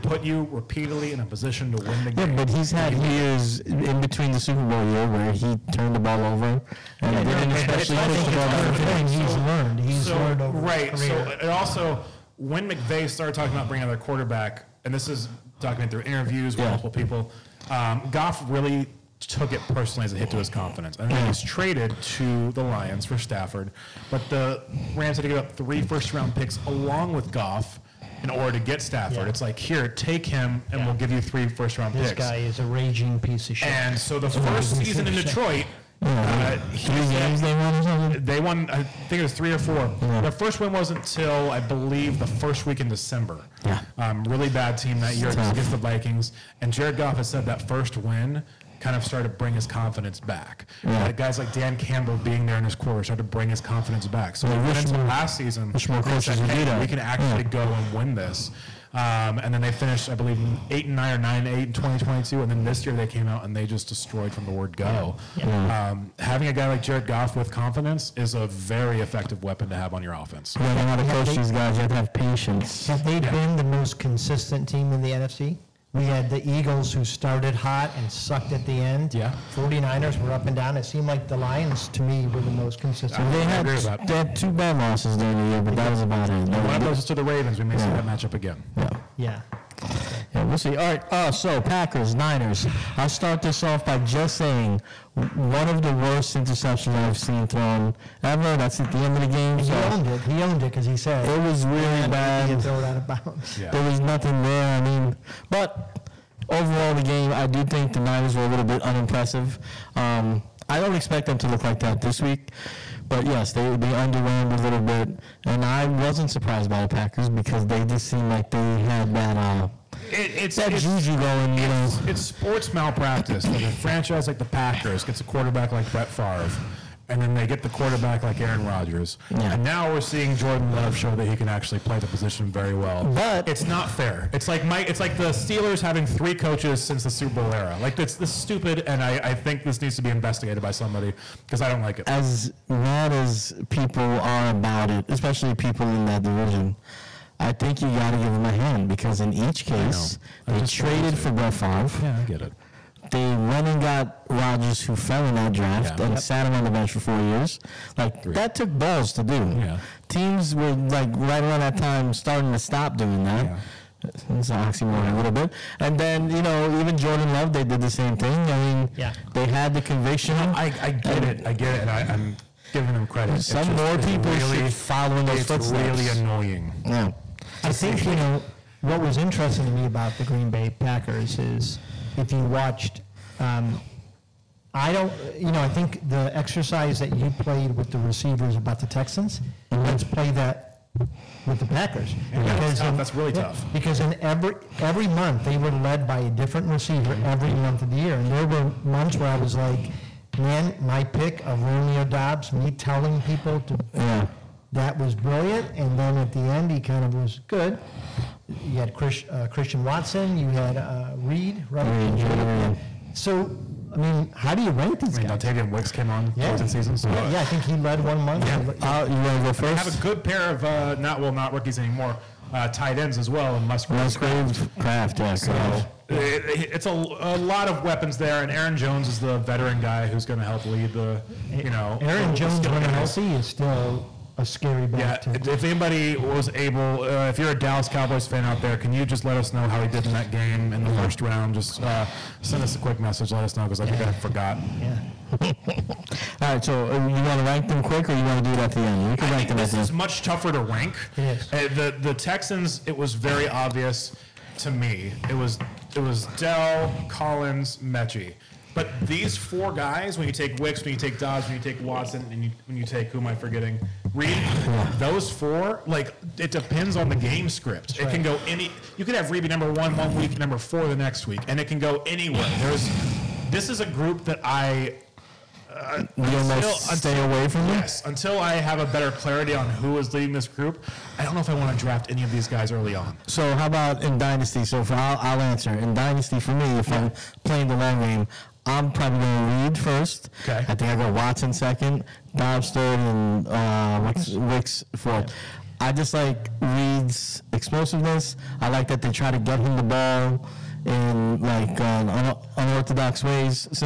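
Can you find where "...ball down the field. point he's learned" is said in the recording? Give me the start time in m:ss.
0:08.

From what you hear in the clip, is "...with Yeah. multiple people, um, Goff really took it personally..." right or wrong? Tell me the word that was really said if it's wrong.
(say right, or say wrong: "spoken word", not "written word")
right.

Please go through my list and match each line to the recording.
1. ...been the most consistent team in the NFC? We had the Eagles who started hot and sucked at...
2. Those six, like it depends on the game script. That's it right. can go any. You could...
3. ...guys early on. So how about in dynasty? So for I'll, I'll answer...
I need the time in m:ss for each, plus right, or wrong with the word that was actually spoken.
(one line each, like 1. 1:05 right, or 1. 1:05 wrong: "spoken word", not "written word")
1. 1:13 right
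2. 4:24 wrong: "four", not "six"
3. 4:42 right.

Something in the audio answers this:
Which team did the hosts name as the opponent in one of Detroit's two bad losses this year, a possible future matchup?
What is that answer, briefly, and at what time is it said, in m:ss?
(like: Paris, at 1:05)
Ravens, at 1:27.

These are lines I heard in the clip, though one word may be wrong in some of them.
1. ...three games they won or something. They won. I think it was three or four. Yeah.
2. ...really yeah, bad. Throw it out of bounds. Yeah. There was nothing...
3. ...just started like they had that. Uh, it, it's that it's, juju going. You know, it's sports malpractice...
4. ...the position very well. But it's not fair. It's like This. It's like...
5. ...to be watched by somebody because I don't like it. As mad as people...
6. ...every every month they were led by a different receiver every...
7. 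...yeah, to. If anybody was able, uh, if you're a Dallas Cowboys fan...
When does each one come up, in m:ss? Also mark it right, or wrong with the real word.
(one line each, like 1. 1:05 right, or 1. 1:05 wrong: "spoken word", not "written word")
1. 0:36 right
2. 1:41 right
3. 1:57 wrong: "seemed", not "started"
4. 2:11 wrong: "Mike", not "This"
5. 2:19 wrong: "investigated", not "watched"
6. 3:14 right
7. 3:55 right.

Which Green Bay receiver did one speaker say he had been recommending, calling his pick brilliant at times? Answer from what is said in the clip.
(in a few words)
Romeo Doubs.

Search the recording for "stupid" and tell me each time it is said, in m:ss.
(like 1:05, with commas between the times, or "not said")
2:18.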